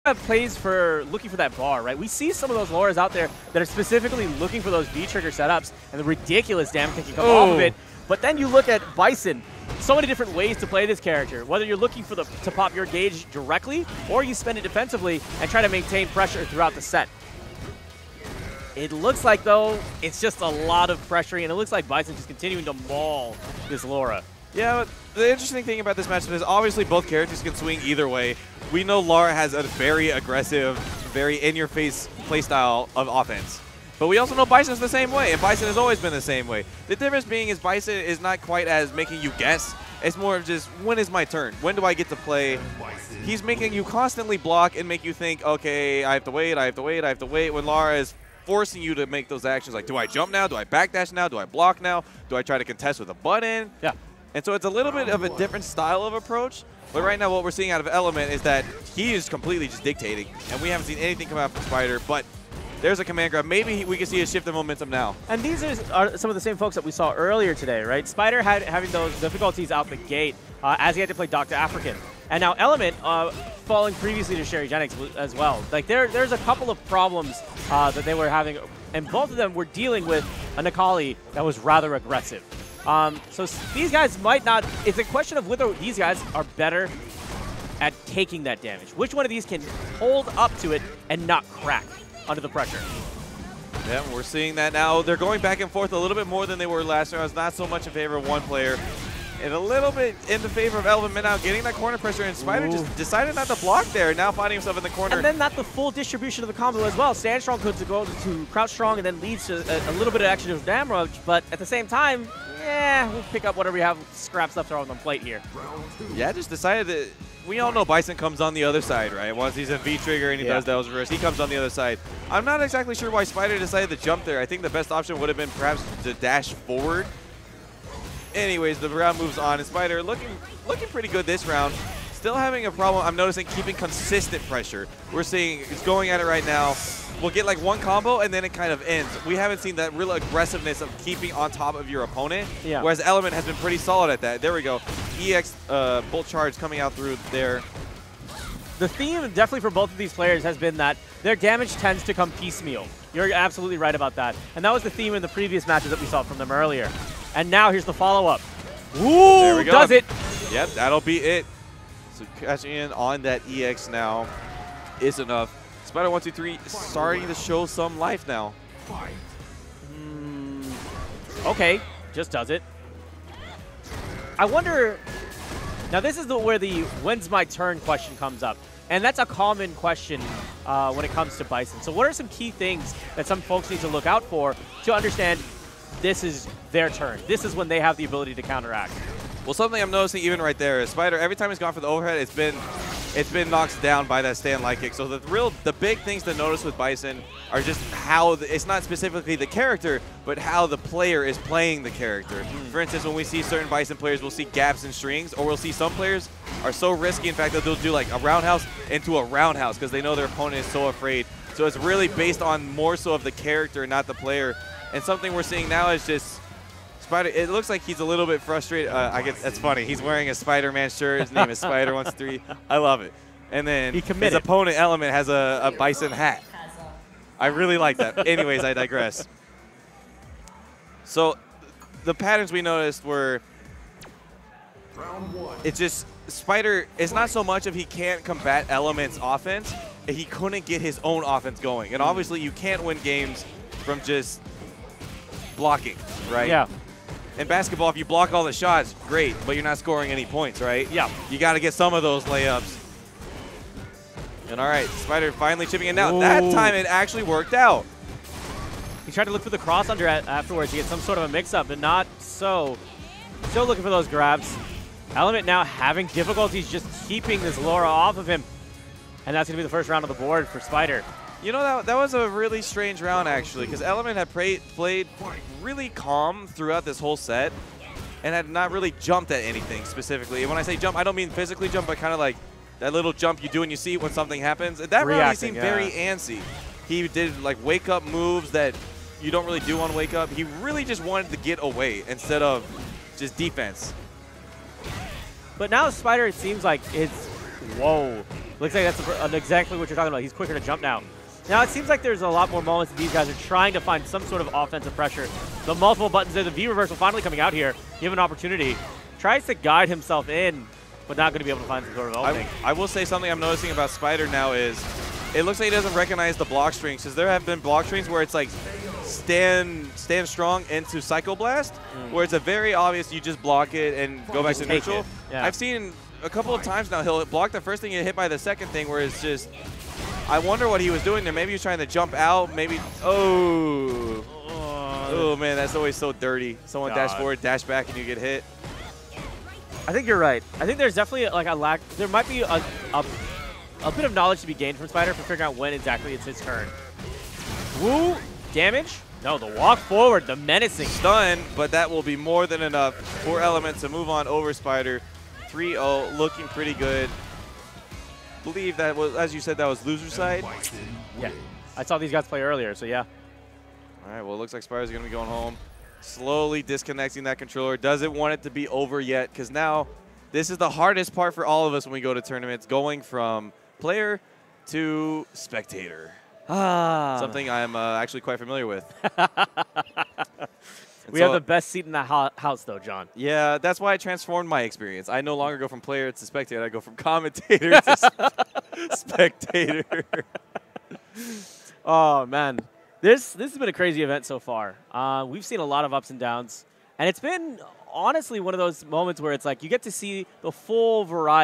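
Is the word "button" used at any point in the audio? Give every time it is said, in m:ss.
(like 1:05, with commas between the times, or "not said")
0:53, 5:06.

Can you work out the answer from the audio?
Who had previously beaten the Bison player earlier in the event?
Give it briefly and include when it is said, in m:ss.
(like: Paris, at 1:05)
Sherry Jennings, at 1:14.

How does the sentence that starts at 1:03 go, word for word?
Maybe we can see a shift in momentum now.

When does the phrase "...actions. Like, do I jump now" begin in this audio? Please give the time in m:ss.
0:49.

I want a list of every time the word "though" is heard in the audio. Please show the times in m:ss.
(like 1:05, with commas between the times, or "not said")
0:19, 6:22.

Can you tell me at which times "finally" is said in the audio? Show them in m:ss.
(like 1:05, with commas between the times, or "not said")
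4:15, 5:06.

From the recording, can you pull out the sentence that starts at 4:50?
He really just wanted to get away instead of just defense.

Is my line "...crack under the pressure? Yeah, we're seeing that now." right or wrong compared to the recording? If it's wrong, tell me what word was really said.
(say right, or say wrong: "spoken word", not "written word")
right.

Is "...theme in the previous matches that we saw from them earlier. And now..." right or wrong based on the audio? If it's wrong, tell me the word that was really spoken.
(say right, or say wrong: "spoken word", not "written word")
right.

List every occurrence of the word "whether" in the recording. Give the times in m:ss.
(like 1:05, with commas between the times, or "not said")
0:11, 1:25.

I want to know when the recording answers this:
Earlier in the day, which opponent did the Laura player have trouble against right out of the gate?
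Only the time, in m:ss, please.
1:11.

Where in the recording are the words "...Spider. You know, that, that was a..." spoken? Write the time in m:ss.
4:30.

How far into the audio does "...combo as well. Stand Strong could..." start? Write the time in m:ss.
1:46.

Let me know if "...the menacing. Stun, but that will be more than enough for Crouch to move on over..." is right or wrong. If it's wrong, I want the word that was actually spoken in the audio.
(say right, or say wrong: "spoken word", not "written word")
wrong: "Element", not "Crouch".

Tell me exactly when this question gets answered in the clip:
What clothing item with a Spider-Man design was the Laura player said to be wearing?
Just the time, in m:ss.
3:40.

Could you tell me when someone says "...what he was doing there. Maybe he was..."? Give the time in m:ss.
5:30.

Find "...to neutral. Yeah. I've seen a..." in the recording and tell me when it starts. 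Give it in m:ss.
5:24.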